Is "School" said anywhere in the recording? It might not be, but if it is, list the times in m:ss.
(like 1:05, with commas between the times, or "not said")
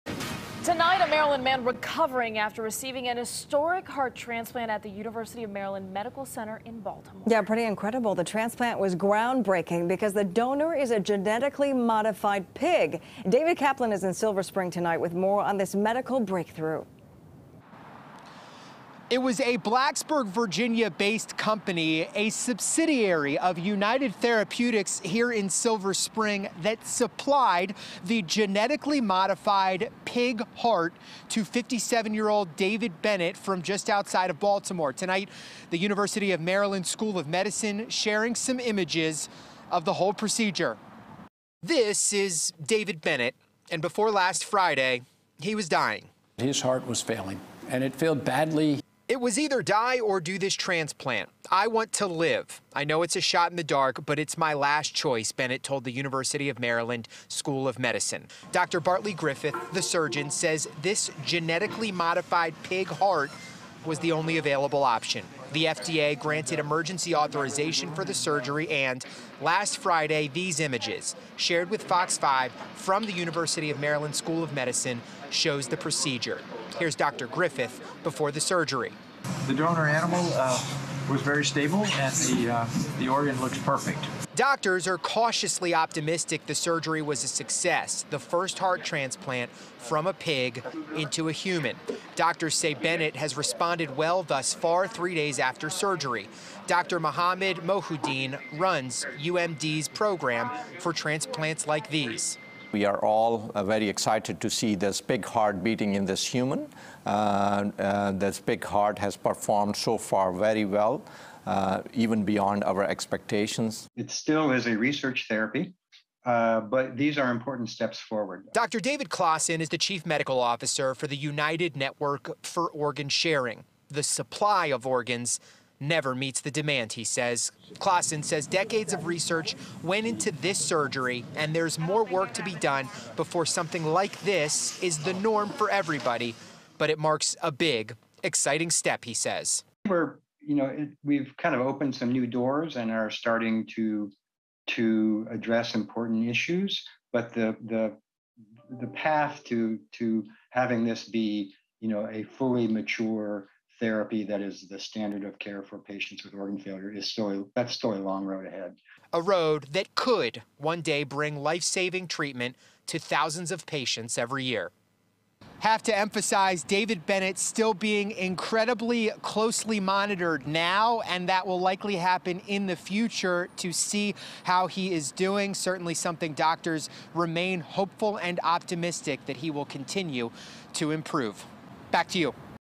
0:36, 0:57, 1:14.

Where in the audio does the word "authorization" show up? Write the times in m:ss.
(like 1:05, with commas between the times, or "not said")
1:07.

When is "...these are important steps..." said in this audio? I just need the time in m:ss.
1:56.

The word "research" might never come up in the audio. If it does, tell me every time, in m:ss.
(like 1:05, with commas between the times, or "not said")
1:54, 2:09.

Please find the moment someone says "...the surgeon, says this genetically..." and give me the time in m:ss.
0:59.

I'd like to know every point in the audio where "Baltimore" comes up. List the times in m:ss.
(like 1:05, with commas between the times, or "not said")
0:06, 0:34.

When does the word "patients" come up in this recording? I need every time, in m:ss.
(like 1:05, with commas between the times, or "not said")
2:35, 2:43.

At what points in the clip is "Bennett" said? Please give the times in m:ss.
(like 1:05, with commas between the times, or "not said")
0:33, 0:43, 0:55, 1:32, 2:47.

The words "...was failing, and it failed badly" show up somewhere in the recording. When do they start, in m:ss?
0:46.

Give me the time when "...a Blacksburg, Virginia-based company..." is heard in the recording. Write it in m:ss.
0:19.